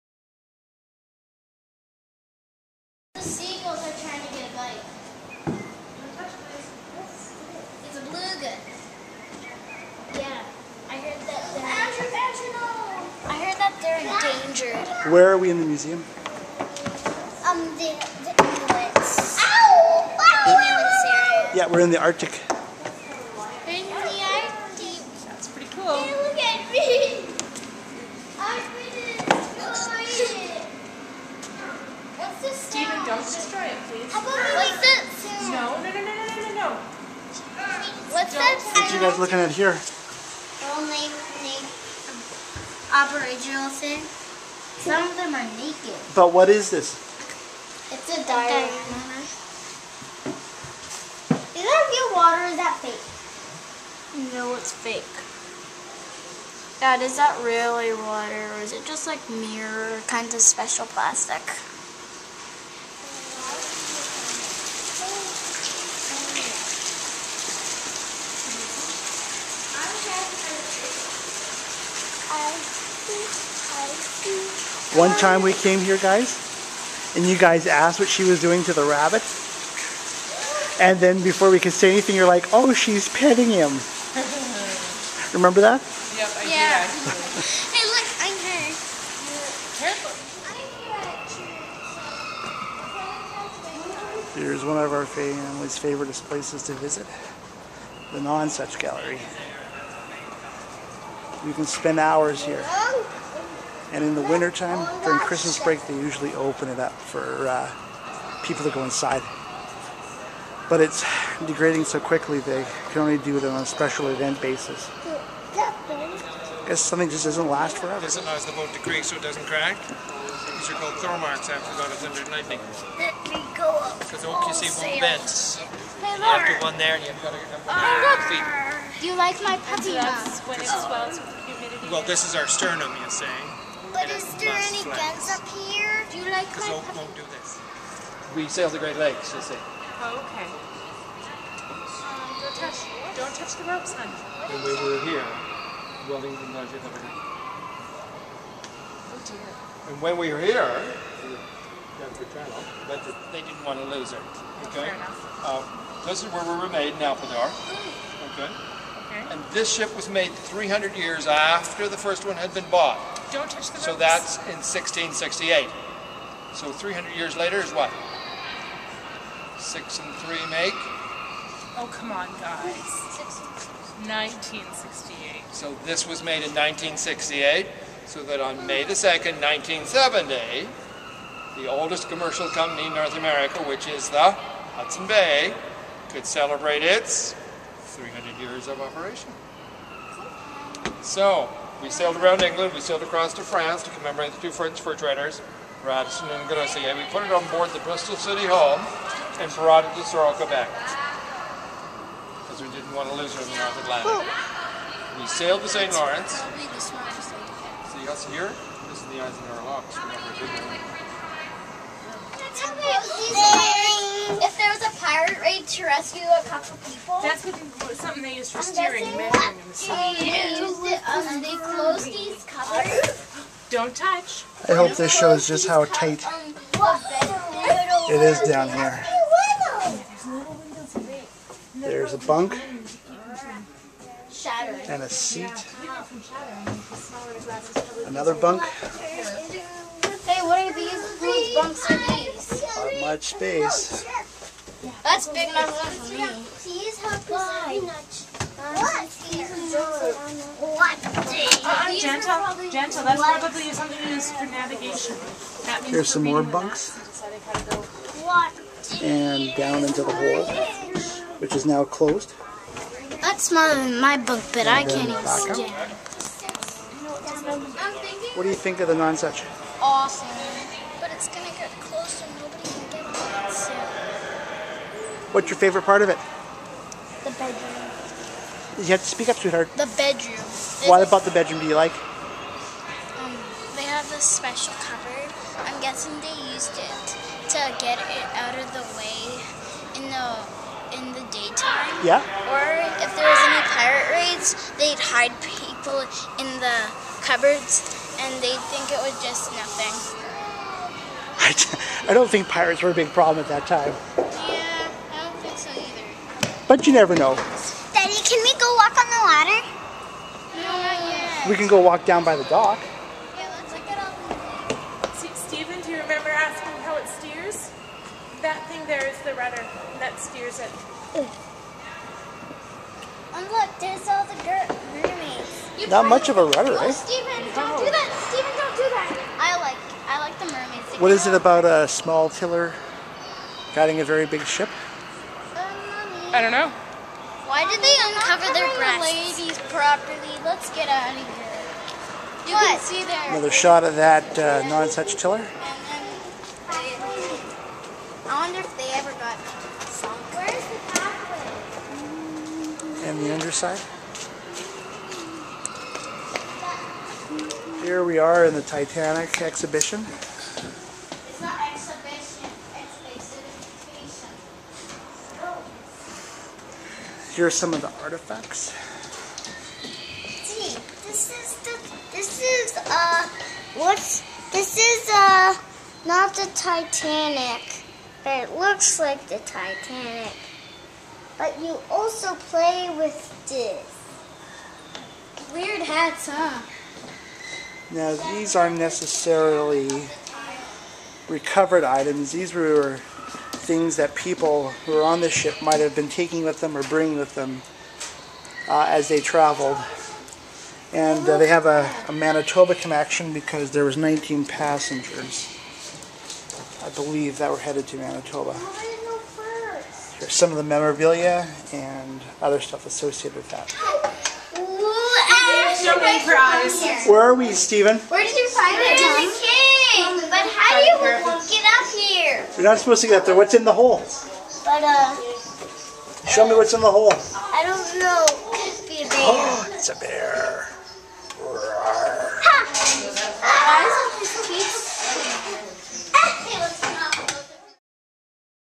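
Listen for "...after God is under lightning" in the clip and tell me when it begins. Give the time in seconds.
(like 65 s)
121 s.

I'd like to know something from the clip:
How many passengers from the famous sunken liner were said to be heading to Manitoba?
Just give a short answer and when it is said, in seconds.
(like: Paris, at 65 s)
19, at 403 s.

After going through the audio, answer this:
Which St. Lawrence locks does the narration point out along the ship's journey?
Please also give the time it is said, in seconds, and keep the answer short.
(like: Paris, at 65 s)
Eisenhower Locks, at 209 s.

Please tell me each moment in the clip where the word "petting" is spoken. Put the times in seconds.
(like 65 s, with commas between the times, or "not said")
83 s.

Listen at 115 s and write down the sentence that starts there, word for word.
I guess something just doesn't last forever.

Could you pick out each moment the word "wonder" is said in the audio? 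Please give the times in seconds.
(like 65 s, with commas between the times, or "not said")
348 s.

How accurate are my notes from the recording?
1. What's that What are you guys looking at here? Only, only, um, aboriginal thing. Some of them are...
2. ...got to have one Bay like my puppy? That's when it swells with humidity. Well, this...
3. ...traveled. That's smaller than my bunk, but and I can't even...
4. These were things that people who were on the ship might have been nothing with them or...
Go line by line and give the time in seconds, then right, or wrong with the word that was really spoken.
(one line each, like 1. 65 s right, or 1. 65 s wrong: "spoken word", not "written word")
1. 38 s right
2. 127 s wrong: "You", not "Bay"
3. 261 s wrong: "closed", not "traveled"
4. 392 s wrong: "taking", not "nothing".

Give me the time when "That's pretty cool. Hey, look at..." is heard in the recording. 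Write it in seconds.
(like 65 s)
25 s.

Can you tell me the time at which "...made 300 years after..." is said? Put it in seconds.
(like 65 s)
160 s.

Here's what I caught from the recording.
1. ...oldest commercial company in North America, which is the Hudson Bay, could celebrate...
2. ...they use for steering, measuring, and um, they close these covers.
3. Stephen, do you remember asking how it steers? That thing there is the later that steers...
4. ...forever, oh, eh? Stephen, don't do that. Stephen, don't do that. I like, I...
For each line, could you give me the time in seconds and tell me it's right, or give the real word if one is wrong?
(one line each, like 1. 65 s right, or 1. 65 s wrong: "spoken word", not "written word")
1. 181 s right
2. 218 s right
3. 315 s wrong: "rudder", not "later"
4. 326 s wrong: "rudder", not "forever".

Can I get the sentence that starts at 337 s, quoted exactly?
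Why did they uncover their breasts?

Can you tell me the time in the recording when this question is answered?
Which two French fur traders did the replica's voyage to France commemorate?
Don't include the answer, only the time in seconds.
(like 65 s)
195 s.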